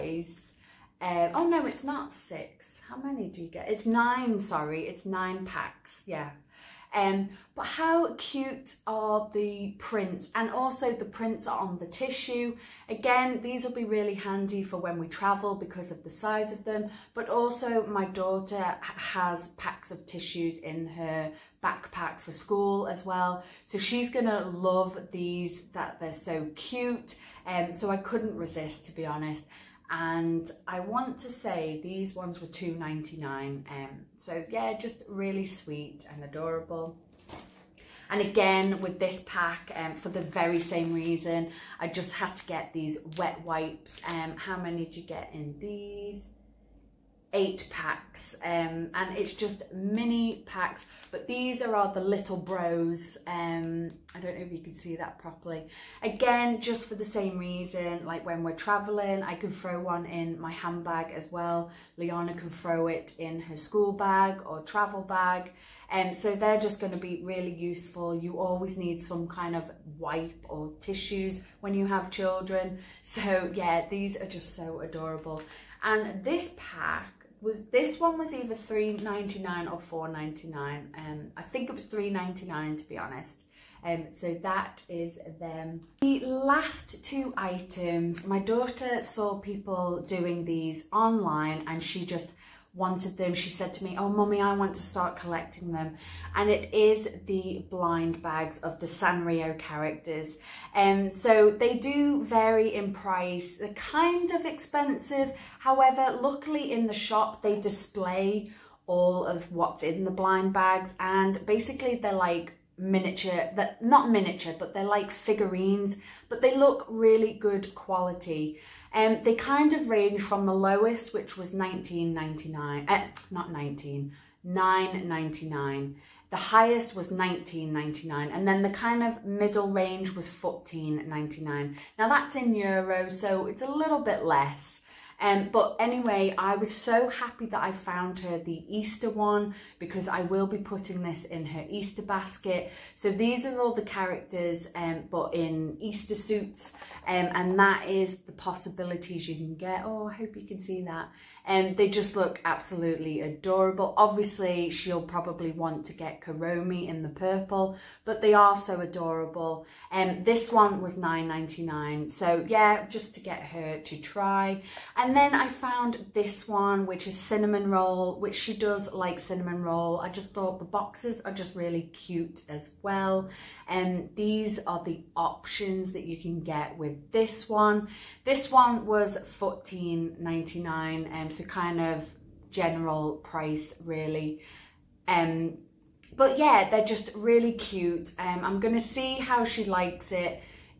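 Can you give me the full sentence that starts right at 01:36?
And it is the blind bags of the Sanrio characters.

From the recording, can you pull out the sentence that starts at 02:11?
Now that's in euro, so it's a little bit less.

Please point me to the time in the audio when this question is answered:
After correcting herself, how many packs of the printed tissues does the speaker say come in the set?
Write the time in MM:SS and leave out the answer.
00:04.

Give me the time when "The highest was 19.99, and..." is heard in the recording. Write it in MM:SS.
02:06.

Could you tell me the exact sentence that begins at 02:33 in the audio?
Obviously, she'll probably want to get Kuromi in the purple, but they are so adorable.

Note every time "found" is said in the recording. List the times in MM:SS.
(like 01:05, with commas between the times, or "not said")
02:17, 02:45.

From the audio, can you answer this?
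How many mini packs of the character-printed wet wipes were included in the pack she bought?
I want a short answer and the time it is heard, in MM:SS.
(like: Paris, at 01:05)
8, at 00:47.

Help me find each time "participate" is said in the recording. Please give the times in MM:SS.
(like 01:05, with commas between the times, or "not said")
not said.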